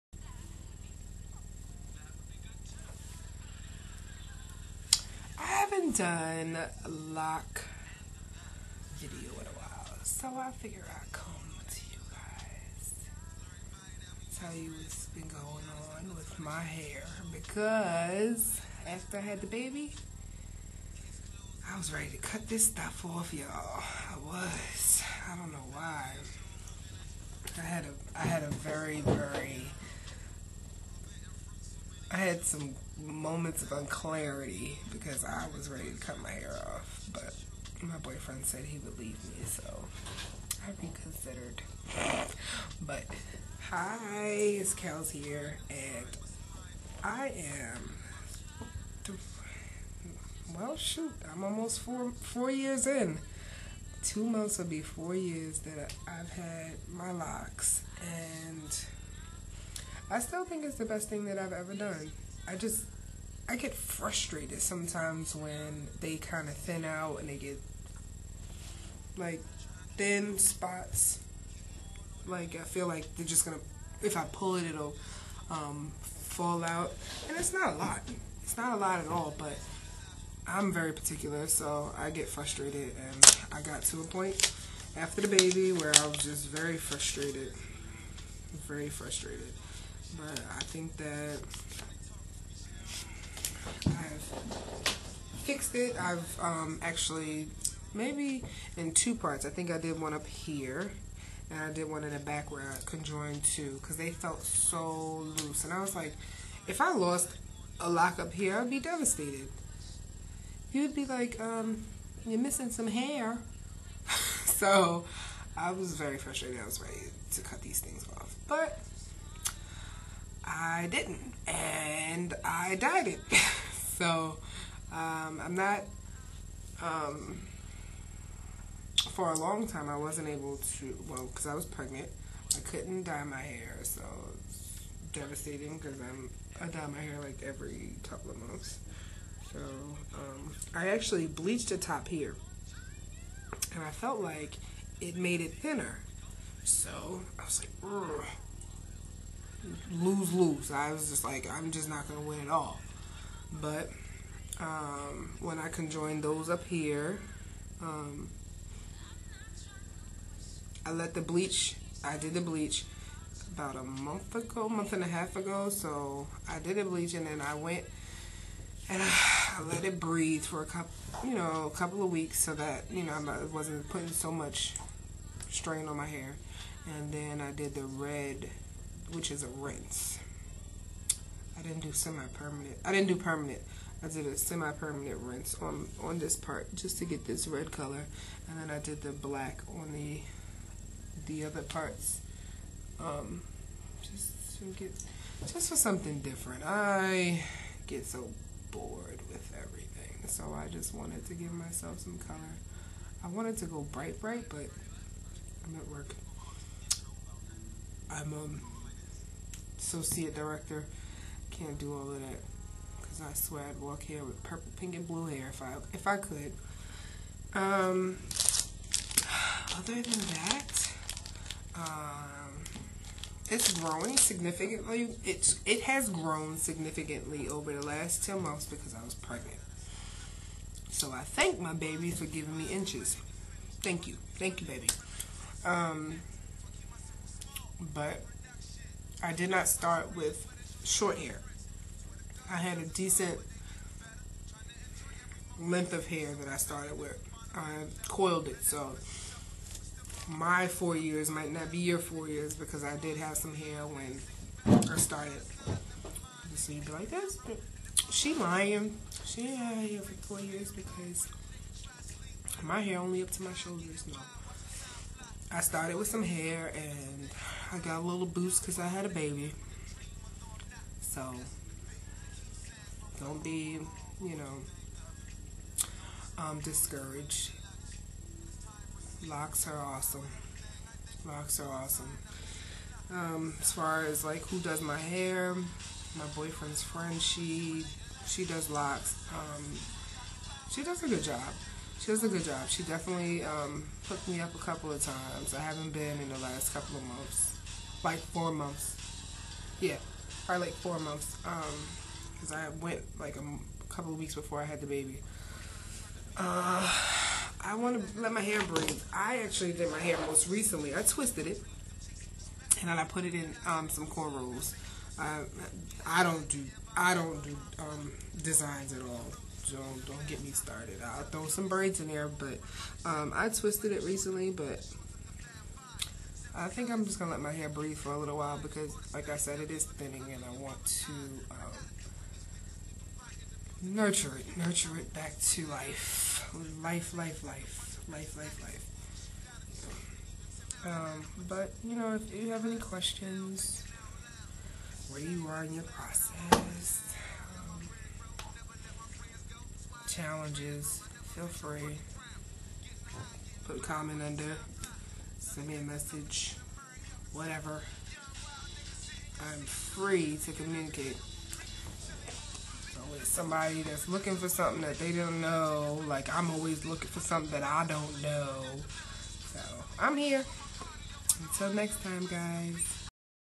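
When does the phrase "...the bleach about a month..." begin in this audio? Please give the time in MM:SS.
02:42.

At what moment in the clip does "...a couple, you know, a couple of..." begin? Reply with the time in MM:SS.
02:50.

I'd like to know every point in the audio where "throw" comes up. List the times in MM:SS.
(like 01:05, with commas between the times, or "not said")
05:21.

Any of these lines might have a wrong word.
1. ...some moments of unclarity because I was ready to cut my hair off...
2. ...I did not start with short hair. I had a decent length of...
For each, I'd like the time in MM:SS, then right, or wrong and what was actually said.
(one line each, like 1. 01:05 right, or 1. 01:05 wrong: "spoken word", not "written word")
1. 00:32 right
2. 03:59 right.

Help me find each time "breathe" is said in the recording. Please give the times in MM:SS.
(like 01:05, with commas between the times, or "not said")
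02:49, 05:08, 05:27.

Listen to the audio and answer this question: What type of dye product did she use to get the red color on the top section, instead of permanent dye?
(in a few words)
semi-permanent rinse.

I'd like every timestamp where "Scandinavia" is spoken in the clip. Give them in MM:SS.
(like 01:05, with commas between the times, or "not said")
not said.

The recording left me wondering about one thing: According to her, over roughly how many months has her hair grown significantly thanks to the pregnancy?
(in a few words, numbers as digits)
10.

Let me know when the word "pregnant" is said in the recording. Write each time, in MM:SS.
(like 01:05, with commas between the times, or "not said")
02:11, 03:49.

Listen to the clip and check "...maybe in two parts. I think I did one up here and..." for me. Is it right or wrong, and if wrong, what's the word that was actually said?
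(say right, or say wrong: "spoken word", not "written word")
right.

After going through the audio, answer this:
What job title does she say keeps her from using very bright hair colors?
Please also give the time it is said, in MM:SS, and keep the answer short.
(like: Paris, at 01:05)
associate director, at 03:29.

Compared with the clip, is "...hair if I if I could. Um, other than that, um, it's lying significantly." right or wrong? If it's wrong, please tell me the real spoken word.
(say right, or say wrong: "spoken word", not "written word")
wrong: "growing", not "lying".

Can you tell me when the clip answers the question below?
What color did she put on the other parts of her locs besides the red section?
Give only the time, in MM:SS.
03:09.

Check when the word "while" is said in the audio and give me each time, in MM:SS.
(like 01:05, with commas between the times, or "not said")
00:09, 05:28.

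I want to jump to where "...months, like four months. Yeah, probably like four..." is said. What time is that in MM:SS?
04:57.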